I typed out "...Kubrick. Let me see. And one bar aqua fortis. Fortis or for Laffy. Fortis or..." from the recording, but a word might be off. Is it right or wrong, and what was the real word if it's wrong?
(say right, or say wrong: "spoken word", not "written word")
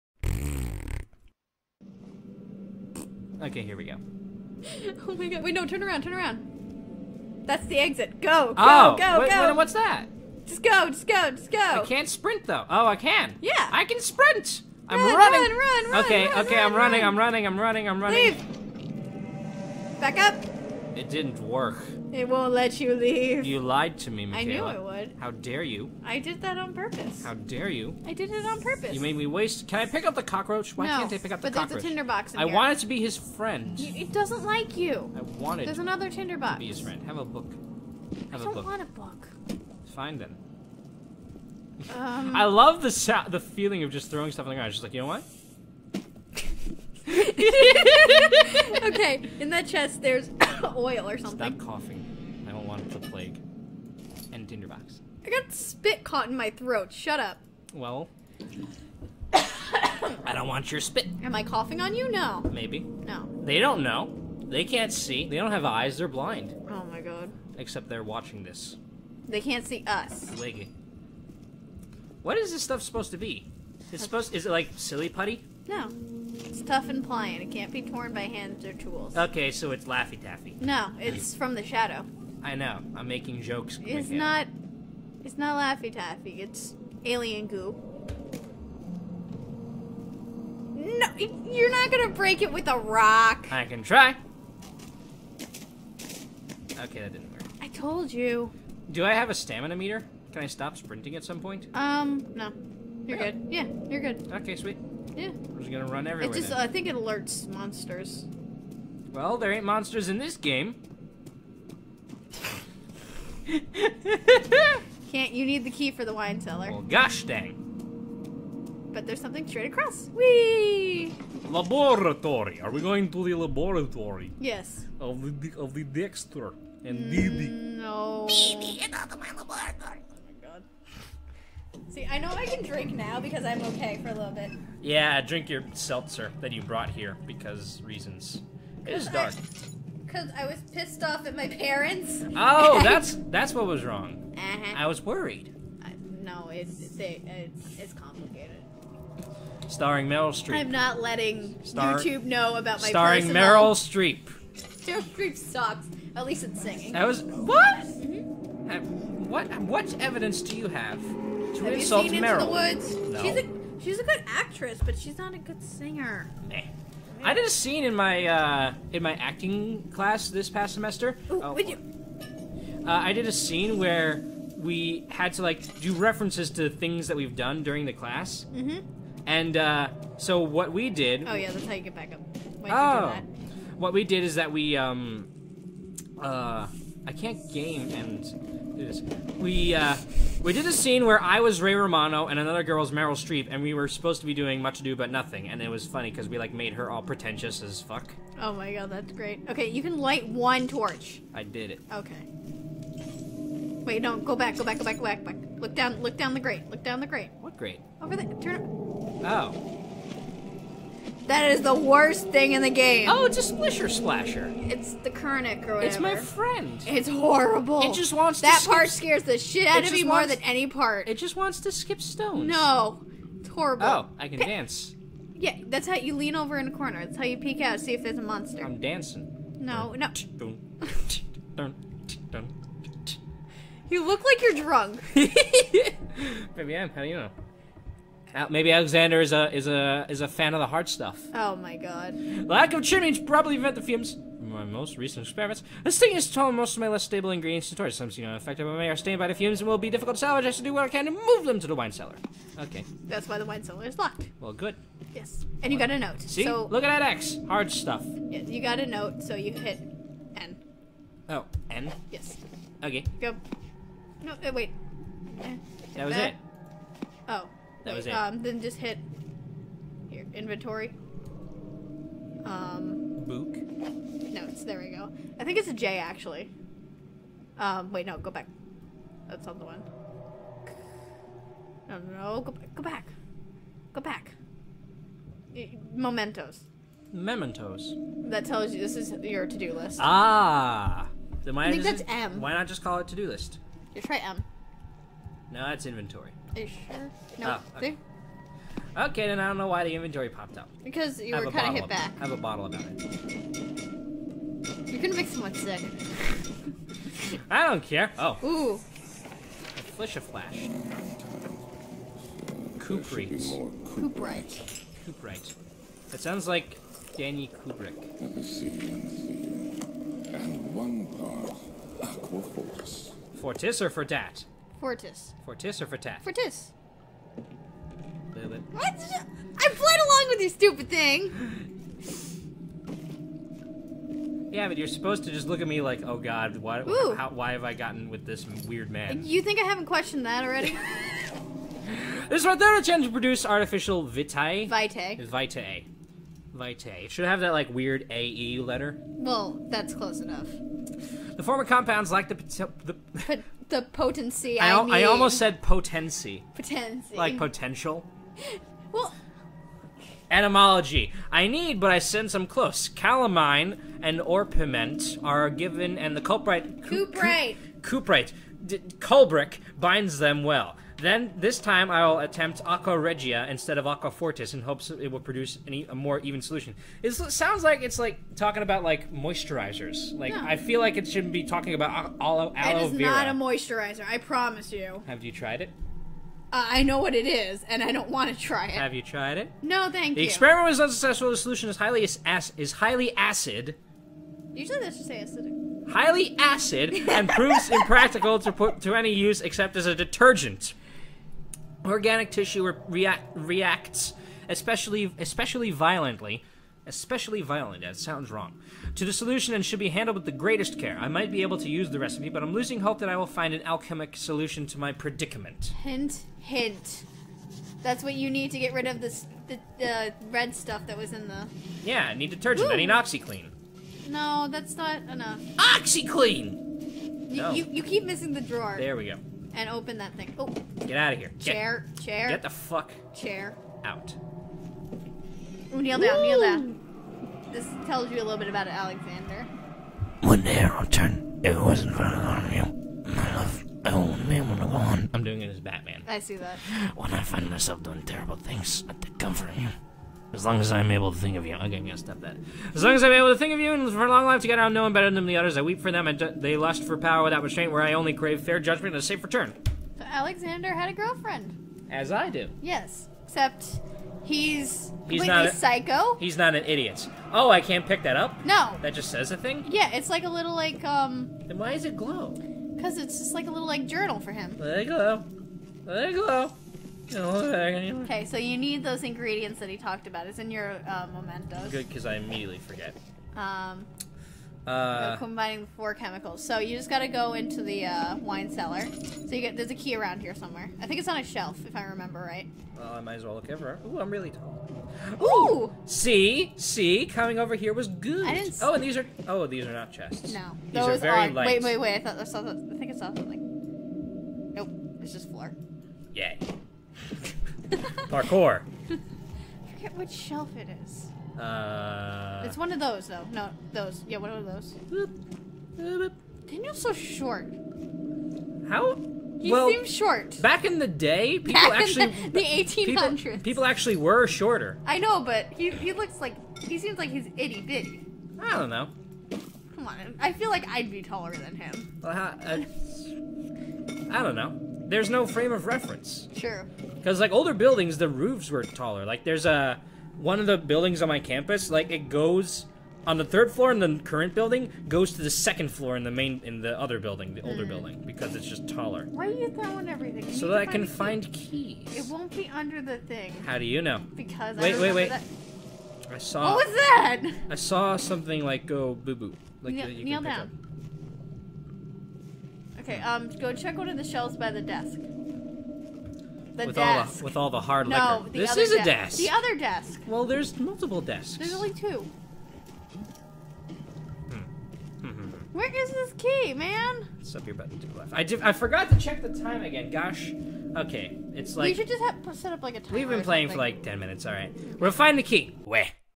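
wrong: "Fortis", not "Laffy".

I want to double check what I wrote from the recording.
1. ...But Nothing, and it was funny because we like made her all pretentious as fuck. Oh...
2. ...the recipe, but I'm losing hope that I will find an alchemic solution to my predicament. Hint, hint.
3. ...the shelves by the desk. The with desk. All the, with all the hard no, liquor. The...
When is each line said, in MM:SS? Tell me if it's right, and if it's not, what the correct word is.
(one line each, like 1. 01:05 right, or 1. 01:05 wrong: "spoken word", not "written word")
1. 03:14 right
2. 06:51 right
3. 09:23 right.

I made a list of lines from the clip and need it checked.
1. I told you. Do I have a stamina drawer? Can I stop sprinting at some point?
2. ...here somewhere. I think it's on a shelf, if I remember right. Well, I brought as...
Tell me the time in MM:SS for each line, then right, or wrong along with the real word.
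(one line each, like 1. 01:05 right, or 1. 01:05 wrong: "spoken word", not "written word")
1. 01:37 wrong: "meter", not "drawer"
2. 08:10 wrong: "might", not "brought".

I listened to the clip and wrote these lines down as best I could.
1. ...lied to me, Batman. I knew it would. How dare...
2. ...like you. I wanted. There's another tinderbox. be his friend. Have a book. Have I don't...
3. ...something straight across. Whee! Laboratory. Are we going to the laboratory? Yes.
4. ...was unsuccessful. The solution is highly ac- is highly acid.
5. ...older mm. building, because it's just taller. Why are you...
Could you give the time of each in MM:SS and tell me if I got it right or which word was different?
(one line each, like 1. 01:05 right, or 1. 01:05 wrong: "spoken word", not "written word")
1. 00:23 wrong: "Michaela", not "Batman"
2. 00:34 right
3. 01:59 right
4. 06:30 right
5. 09:07 right.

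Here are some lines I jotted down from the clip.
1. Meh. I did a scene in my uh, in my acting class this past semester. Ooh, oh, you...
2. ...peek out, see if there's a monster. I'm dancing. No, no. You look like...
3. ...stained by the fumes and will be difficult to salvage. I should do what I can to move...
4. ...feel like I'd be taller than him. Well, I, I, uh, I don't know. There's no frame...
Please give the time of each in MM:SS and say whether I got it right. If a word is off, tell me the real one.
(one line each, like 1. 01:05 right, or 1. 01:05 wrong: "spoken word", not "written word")
1. 02:46 right
2. 03:47 right
3. 04:08 right
4. 08:50 right.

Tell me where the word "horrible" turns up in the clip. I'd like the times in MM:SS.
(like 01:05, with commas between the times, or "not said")
03:37, 03:43.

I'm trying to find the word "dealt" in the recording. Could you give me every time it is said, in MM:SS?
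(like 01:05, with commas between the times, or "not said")
not said.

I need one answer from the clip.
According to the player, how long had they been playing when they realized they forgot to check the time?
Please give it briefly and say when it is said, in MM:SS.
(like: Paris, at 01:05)
10 minutes, at 09:43.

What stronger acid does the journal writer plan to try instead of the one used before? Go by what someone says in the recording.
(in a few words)
Aqua Regia.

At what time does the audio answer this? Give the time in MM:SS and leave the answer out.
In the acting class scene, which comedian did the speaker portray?
03:11.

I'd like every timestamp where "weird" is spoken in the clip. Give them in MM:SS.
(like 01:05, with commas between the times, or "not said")
05:38, 05:47.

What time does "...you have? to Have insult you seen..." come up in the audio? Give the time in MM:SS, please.
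02:40.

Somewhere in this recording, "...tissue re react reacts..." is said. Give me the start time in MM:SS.
06:42.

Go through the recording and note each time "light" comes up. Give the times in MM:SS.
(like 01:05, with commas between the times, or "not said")
03:19, 08:21.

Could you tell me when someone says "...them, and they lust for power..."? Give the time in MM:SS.
07:35.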